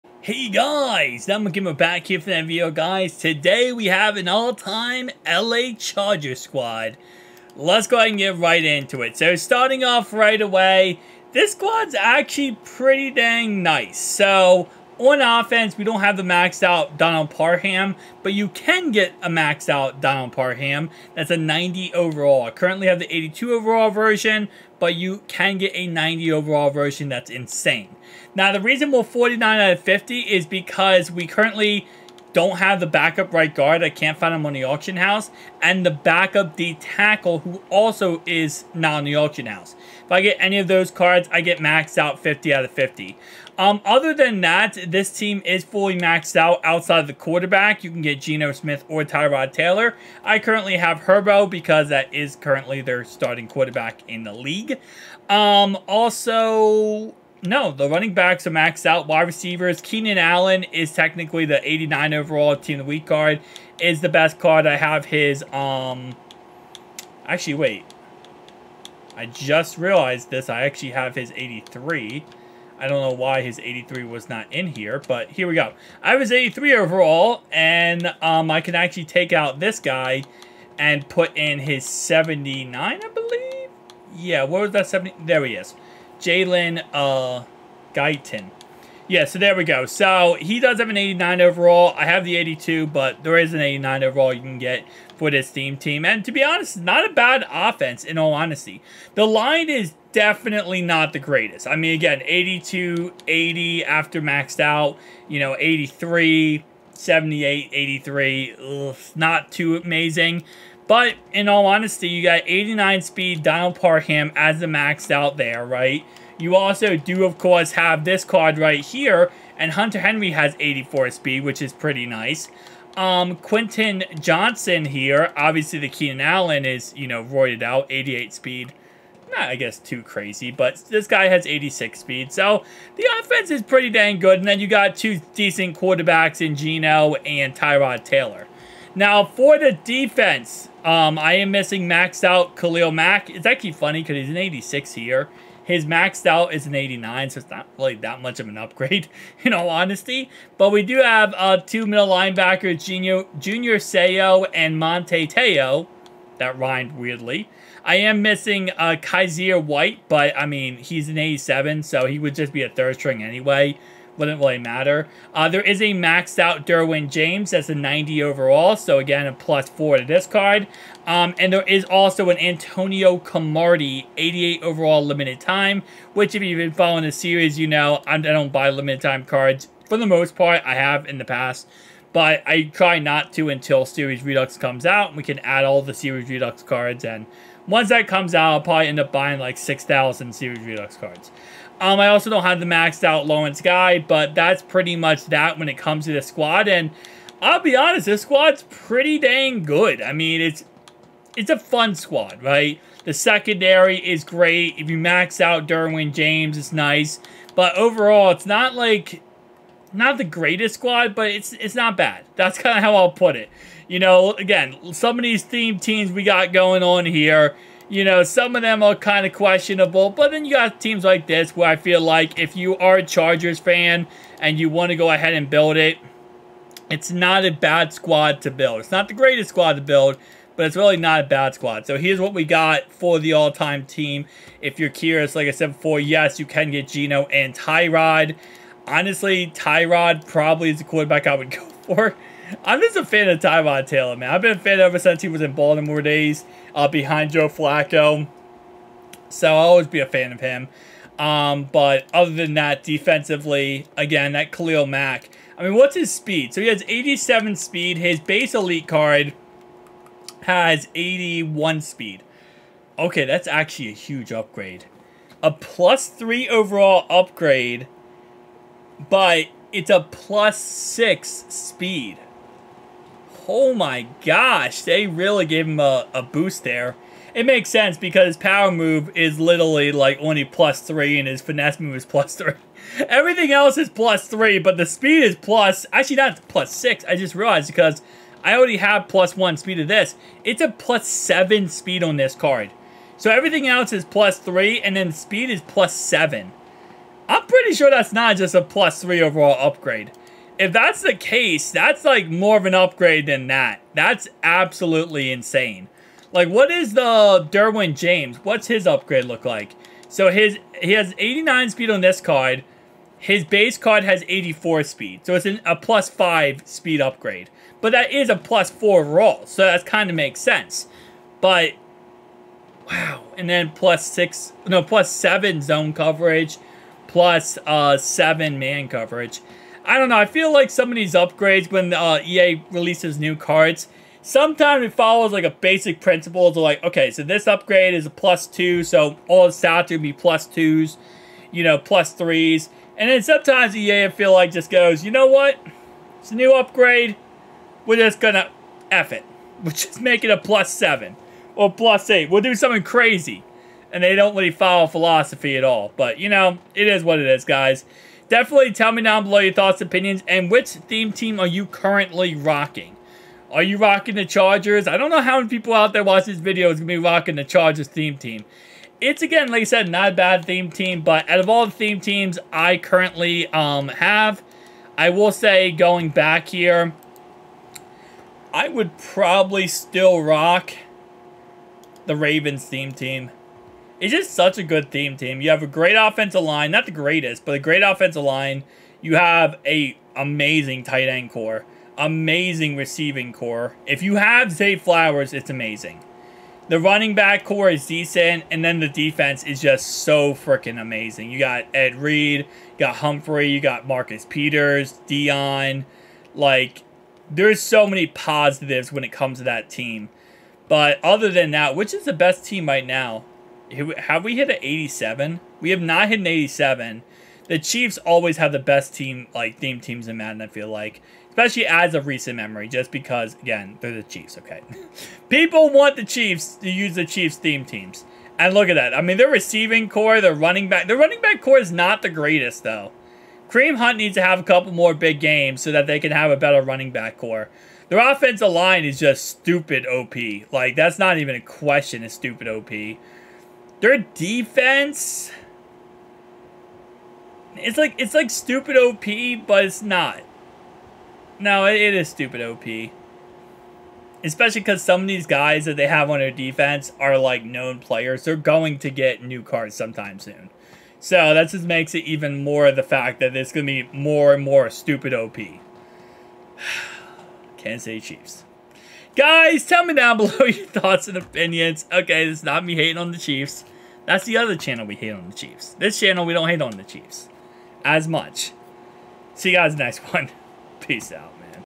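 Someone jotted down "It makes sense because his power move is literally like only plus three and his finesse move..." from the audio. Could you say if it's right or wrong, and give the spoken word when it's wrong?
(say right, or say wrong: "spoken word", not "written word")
right.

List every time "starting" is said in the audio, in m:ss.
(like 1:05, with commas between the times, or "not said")
0:09, 0:53.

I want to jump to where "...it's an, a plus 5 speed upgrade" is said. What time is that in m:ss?
5:15.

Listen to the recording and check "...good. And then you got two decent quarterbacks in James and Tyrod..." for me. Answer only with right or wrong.
wrong.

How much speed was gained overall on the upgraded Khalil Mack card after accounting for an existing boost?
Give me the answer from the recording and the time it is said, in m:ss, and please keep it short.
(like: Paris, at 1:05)
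plus 7, at 4:50.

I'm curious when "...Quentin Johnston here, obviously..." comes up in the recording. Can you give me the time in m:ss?
2:03.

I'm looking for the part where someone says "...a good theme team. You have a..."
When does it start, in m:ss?
6:24.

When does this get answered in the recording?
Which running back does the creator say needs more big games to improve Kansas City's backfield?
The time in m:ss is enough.
7:13.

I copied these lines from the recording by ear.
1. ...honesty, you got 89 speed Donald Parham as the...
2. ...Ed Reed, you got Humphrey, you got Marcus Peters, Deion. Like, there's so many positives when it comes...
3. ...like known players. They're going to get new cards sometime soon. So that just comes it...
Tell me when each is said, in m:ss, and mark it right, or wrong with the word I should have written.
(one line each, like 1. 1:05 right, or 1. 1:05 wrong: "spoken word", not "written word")
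1. 1:51 right
2. 6:41 right
3. 7:37 wrong: "makes", not "comes".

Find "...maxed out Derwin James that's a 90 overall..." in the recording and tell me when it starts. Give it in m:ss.
2:45.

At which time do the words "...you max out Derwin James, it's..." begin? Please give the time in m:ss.
3:24.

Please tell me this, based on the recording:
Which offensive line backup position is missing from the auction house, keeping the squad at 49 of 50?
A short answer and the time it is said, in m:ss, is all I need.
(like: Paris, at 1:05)
backup right guard, at 0:32.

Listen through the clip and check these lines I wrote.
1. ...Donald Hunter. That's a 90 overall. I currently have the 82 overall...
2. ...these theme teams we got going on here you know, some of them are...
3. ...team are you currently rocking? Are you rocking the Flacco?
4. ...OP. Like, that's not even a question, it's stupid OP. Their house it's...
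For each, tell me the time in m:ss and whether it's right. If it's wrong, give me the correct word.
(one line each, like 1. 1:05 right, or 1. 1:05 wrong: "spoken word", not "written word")
1. 0:20 wrong: "Parham", not "Hunter"
2. 3:35 right
3. 6:01 wrong: "Chargers", not "Flacco"
4. 7:19 wrong: "defense", not "house".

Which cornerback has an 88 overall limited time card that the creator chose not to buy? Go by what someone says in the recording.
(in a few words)
Antonio Cromartie.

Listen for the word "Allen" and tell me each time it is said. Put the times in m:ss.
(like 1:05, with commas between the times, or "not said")
1:00, 2:06.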